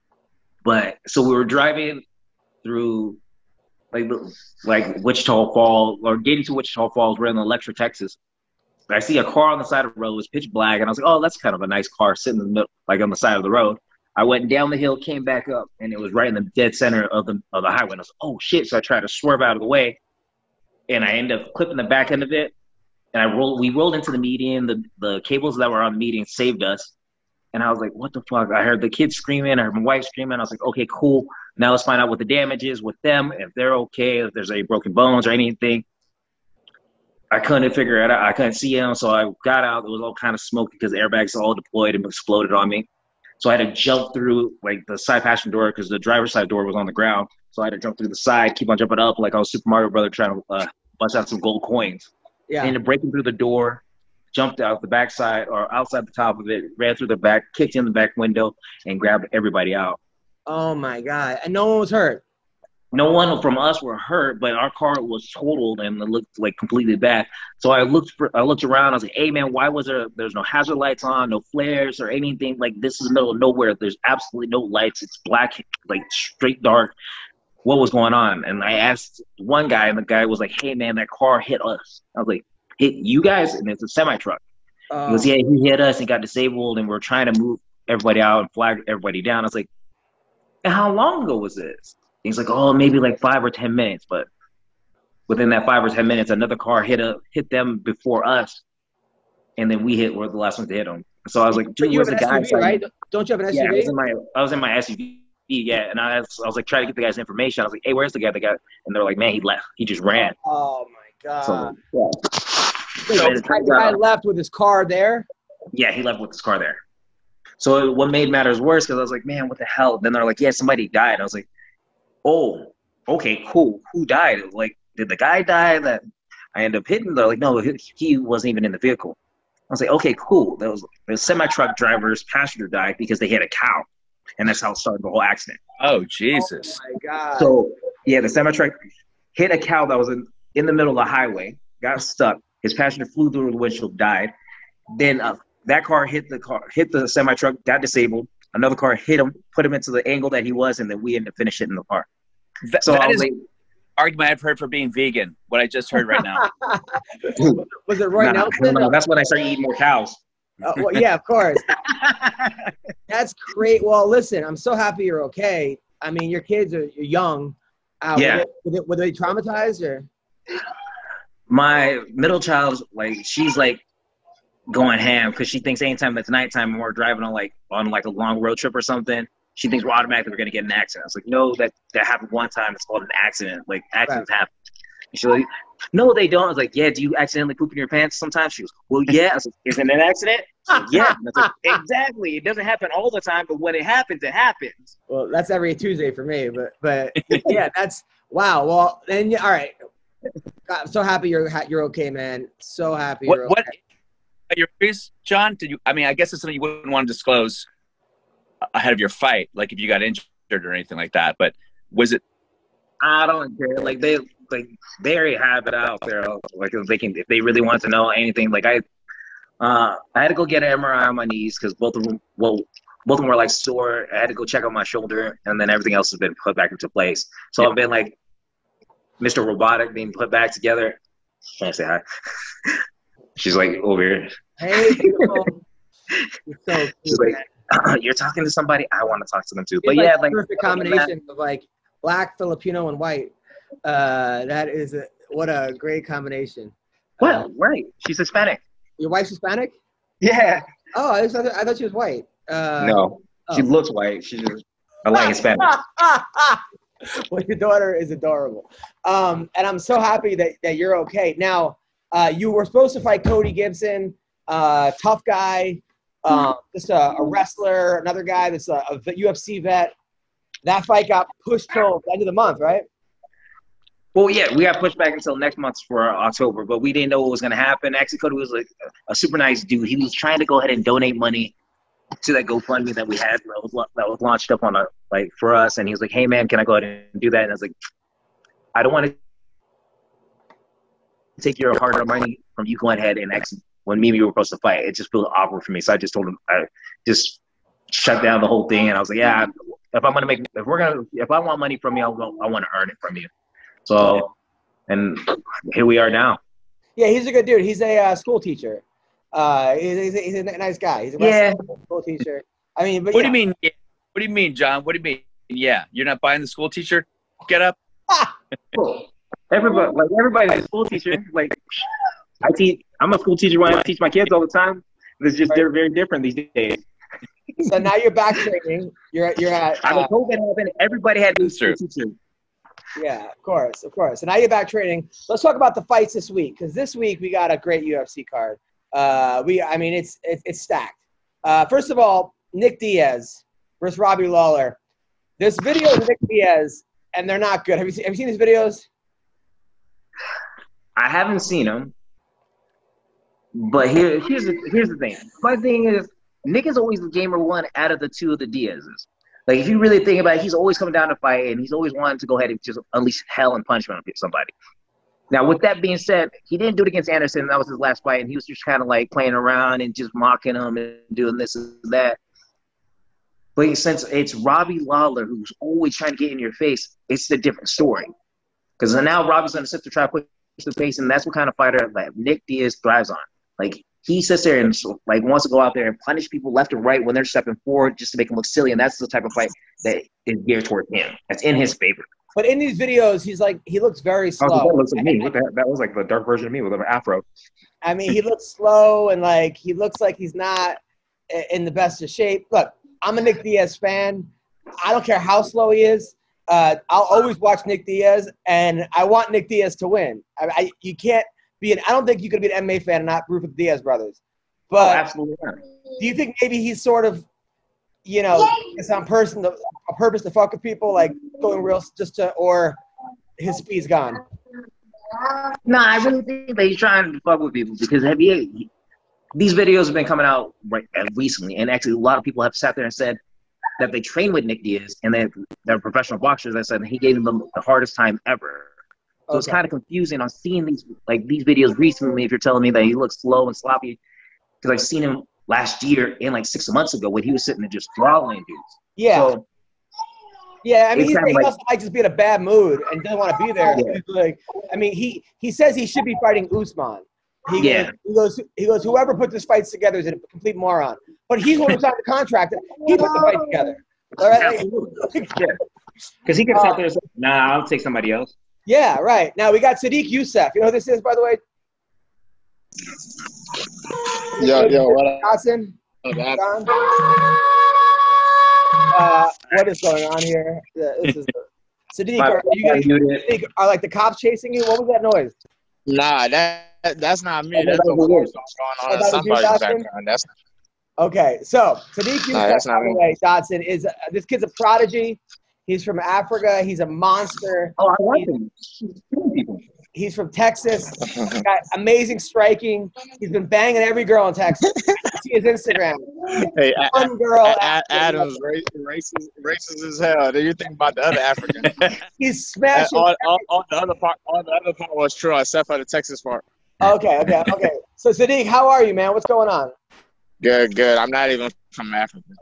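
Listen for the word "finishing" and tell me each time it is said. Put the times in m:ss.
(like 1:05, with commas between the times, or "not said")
2:31.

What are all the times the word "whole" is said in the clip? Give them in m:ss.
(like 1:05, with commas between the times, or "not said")
2:15, 4:58.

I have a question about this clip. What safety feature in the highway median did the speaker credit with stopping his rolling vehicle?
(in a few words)
The cables.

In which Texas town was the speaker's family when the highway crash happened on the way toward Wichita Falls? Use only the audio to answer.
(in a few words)
Electra.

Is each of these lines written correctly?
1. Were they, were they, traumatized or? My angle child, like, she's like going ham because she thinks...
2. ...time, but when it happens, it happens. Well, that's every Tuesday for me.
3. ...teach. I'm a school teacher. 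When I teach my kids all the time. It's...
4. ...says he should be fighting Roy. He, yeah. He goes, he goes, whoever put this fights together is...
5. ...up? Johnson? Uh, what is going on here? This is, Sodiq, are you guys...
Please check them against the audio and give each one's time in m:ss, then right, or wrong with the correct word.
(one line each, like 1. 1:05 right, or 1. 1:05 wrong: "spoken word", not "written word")
1. 2:48 wrong: "middle", not "angle"
2. 3:13 right
3. 5:22 right
4. 7:35 wrong: "Usman", not "Roy"
5. 7:55 right.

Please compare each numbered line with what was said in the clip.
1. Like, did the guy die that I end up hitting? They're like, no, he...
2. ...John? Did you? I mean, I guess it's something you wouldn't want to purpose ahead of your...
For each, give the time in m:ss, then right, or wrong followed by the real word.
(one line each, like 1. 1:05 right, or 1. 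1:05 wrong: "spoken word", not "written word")
1. 2:04 right
2. 3:25 wrong: "disclose", not "purpose".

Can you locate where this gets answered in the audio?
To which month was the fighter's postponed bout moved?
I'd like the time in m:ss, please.
4:36.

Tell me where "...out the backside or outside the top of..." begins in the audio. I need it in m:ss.
0:54.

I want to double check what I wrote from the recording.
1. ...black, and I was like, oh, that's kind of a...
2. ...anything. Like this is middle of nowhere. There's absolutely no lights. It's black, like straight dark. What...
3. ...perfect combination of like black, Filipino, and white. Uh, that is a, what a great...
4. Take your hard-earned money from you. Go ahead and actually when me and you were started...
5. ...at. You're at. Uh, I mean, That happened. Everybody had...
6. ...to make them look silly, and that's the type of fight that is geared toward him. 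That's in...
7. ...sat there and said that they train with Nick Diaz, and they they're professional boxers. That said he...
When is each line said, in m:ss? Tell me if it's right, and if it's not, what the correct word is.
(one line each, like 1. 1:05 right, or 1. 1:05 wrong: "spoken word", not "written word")
1. 0:10 right
2. 1:12 right
3. 4:00 right
4. 4:51 wrong: "supposed", not "started"
5. 5:29 wrong: "COVID", not "That"
6. 6:28 right
7. 7:12 right.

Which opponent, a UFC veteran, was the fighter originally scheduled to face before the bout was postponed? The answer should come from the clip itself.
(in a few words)
Cody Gibson.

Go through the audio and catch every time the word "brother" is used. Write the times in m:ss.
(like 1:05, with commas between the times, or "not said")
0:49, 6:53.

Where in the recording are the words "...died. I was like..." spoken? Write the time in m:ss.
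2:00.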